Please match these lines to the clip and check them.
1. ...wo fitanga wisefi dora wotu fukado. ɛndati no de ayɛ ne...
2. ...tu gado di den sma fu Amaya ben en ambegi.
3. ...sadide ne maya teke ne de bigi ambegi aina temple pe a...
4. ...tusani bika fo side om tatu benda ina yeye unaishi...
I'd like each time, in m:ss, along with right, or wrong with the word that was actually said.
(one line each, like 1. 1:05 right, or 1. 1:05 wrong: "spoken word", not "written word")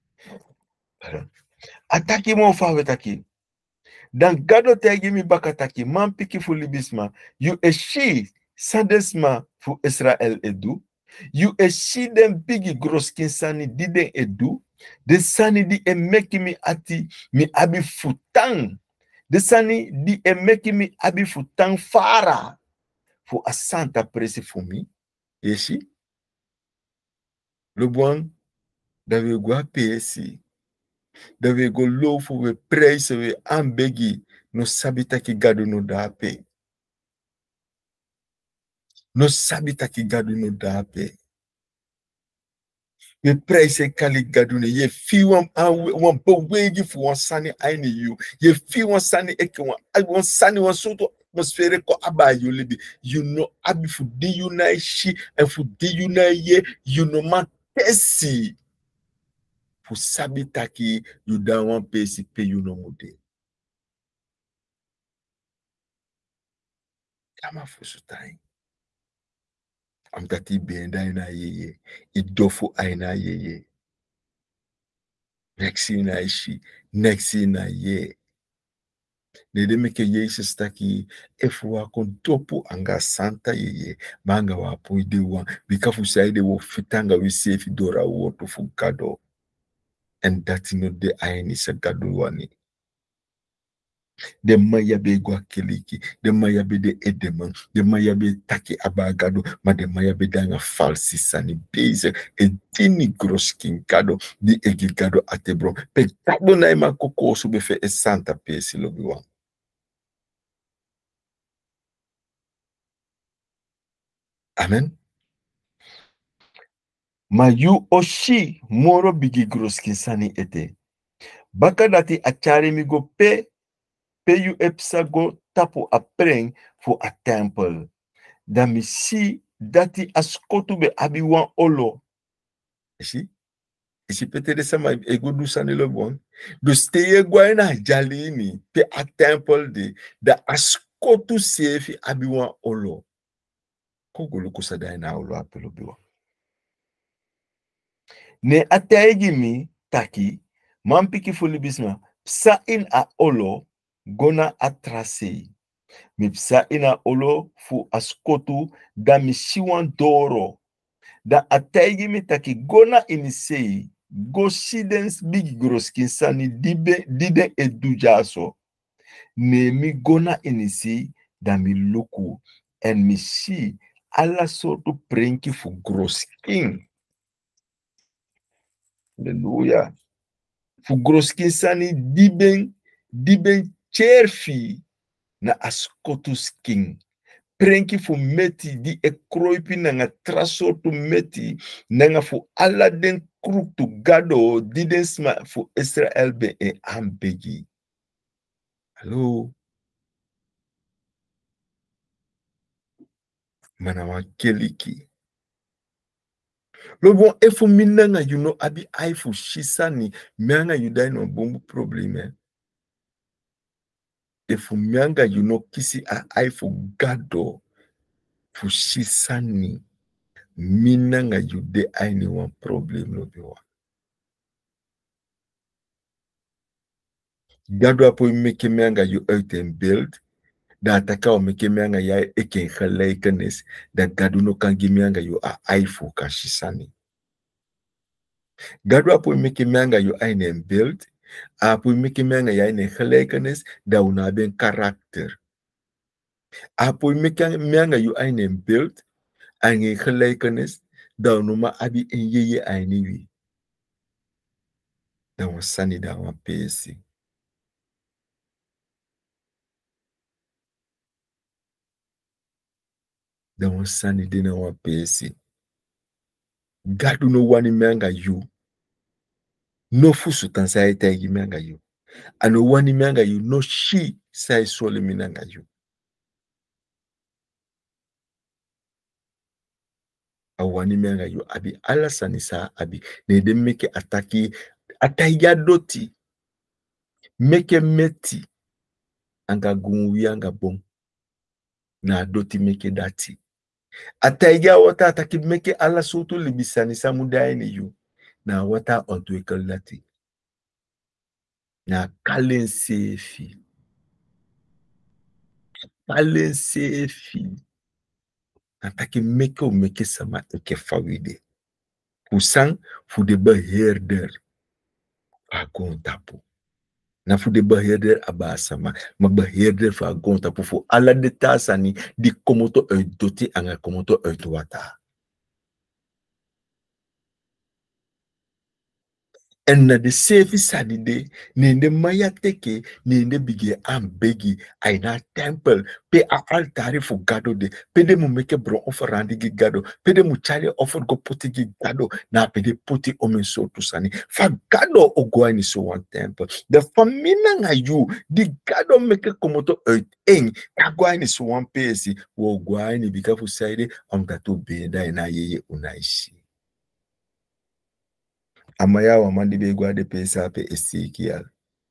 1. 1:26 right
2. 3:13 wrong: "Israel", not "Amaya"
3. 5:30 right
4. 5:52 wrong: "goani", not "tusani".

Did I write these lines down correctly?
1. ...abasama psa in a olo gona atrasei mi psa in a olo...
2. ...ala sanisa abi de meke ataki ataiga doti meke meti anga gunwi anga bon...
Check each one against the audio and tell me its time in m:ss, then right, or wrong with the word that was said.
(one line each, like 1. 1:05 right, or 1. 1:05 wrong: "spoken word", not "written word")
1. 2:31 wrong: "bisma", not "abasama"
2. 4:41 right.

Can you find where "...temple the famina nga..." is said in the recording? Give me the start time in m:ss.
5:46.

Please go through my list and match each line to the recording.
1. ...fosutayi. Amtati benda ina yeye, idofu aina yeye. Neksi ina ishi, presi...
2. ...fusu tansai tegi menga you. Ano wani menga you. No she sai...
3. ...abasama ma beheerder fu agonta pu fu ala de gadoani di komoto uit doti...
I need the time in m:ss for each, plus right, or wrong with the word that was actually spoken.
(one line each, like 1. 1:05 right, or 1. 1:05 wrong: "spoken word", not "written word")
1. 1:07 wrong: "neksi", not "presi"
2. 4:30 right
3. 5:18 wrong: "tasani", not "gadoani".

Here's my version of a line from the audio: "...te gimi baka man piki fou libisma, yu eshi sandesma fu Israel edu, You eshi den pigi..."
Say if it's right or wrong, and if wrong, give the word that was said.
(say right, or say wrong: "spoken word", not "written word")
right.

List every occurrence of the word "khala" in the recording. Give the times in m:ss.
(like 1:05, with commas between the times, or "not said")
3:52, 4:02, 4:10.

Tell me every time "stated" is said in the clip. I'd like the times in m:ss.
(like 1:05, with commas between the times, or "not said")
not said.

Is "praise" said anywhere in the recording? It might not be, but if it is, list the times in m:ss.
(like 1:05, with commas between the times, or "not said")
0:32, 0:43.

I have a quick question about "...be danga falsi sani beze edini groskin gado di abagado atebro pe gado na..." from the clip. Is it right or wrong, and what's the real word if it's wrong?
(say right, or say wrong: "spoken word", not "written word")
wrong: "egigado", not "abagado".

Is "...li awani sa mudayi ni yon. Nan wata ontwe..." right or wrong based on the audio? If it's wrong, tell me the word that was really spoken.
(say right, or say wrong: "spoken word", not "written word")
wrong: "bisani", not "awani".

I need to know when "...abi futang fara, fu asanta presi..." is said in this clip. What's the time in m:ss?
0:20.